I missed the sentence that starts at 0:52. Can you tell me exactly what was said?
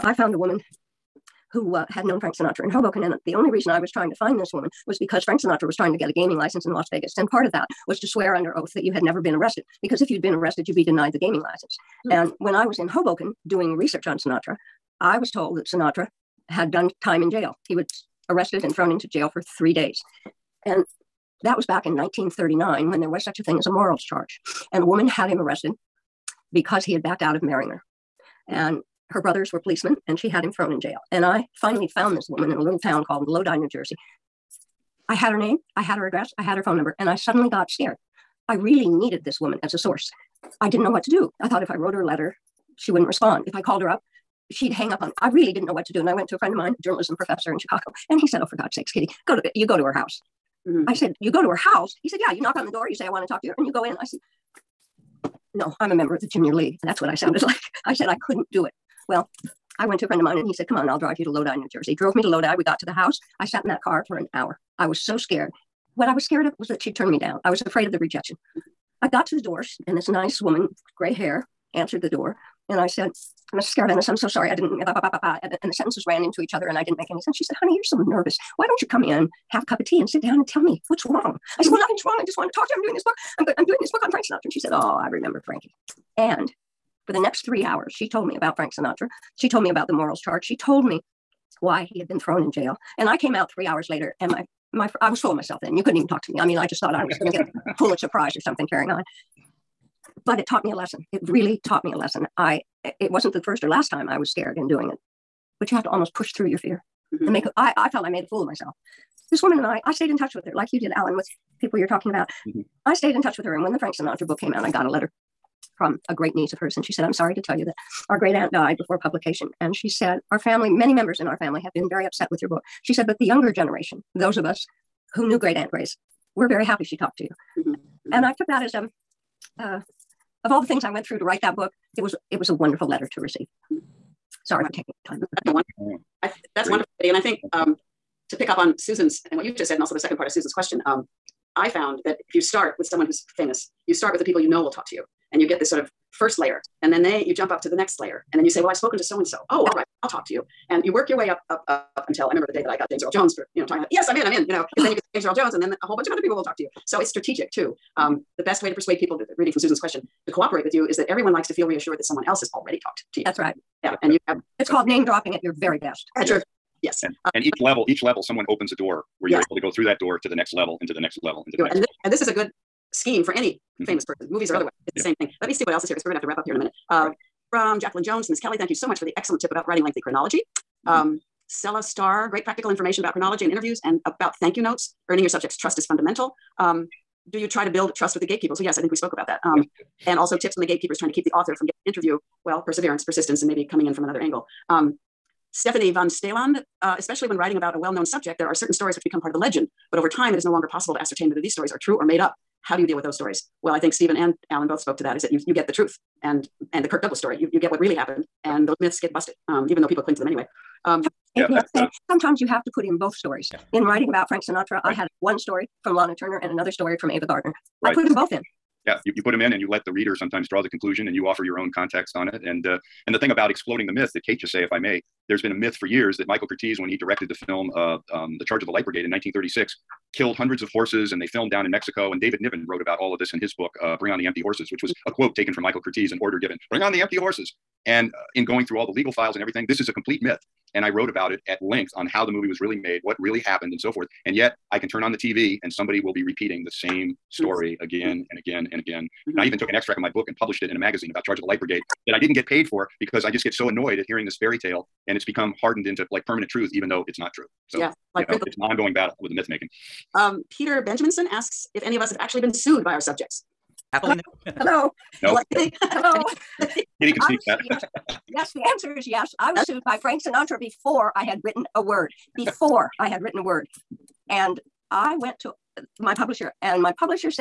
He said, Yeah, you knock on the door, you say, I want to talk to you, and you go in.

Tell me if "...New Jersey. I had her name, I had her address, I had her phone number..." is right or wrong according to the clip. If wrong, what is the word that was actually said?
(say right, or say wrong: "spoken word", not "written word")
right.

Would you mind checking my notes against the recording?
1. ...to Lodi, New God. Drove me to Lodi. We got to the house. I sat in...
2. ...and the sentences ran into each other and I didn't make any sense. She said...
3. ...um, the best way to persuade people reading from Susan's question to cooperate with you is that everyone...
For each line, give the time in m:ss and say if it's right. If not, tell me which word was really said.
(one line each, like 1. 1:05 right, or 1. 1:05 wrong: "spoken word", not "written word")
1. 1:01 wrong: "Jersey", not "God"
2. 1:15 right
3. 2:37 right.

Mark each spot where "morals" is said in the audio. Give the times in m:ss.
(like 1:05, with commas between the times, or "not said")
0:23, 1:29.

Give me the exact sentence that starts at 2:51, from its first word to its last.
And this, and this is a good scheme for any mm-hmm.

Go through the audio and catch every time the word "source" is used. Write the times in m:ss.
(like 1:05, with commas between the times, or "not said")
0:39.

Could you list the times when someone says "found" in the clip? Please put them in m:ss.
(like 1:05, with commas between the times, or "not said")
0:00, 0:31, 2:21.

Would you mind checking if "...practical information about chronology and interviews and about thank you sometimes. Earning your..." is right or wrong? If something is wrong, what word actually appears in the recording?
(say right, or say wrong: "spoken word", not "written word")
wrong: "notes", not "sometimes".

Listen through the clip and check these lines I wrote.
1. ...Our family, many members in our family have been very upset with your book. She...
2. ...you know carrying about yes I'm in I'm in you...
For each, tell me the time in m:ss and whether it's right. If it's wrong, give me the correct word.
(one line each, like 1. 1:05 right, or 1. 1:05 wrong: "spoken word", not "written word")
1. 2:00 right
2. 2:33 wrong: "talking", not "carrying".